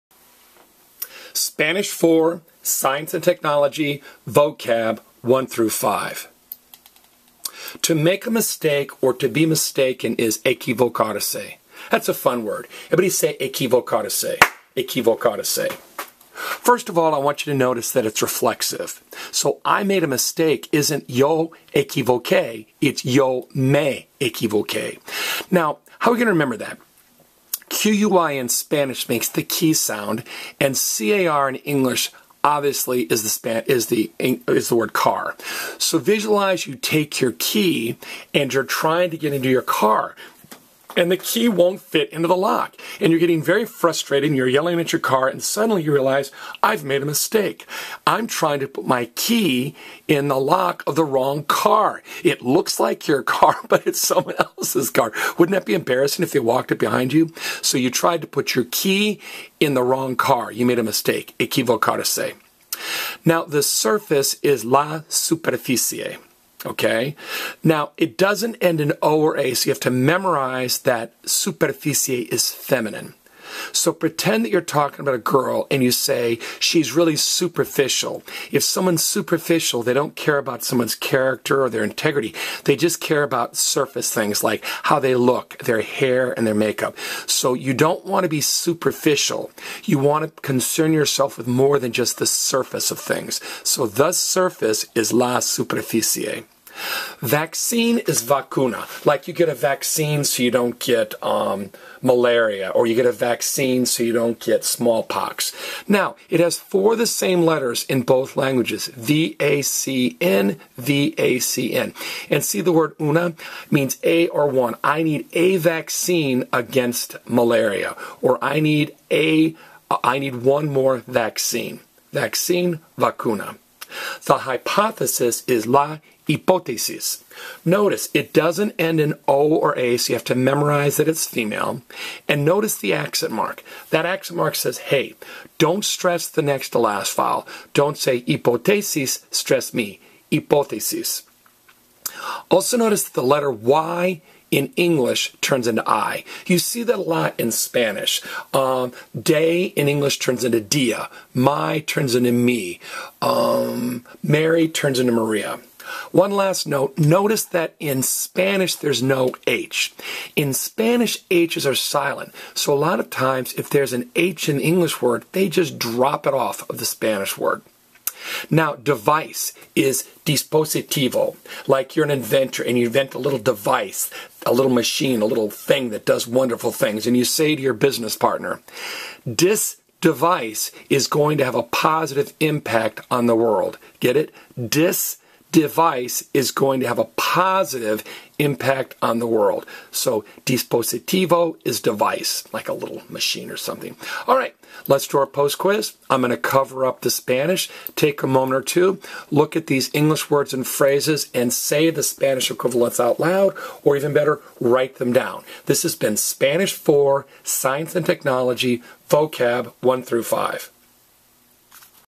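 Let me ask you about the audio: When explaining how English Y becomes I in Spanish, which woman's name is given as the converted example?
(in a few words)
Maria.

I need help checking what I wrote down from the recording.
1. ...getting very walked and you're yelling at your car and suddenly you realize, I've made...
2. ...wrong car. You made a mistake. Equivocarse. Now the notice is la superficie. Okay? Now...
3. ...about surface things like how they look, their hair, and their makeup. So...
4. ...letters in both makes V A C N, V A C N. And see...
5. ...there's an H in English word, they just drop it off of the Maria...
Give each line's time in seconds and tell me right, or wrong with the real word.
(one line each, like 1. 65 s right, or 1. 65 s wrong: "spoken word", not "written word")
1. 43 s wrong: "frustrated", not "walked"
2. 59 s wrong: "surface", not "notice"
3. 83 s right
4. 107 s wrong: "languages", not "makes"
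5. 163 s wrong: "Spanish", not "Maria".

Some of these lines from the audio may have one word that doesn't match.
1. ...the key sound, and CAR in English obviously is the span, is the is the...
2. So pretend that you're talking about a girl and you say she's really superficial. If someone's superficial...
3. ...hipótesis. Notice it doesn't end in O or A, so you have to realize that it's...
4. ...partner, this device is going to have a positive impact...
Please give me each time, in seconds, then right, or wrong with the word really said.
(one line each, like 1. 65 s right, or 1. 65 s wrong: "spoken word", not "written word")
1. 29 s right
2. 73 s right
3. 126 s wrong: "memorize", not "realize"
4. 178 s right.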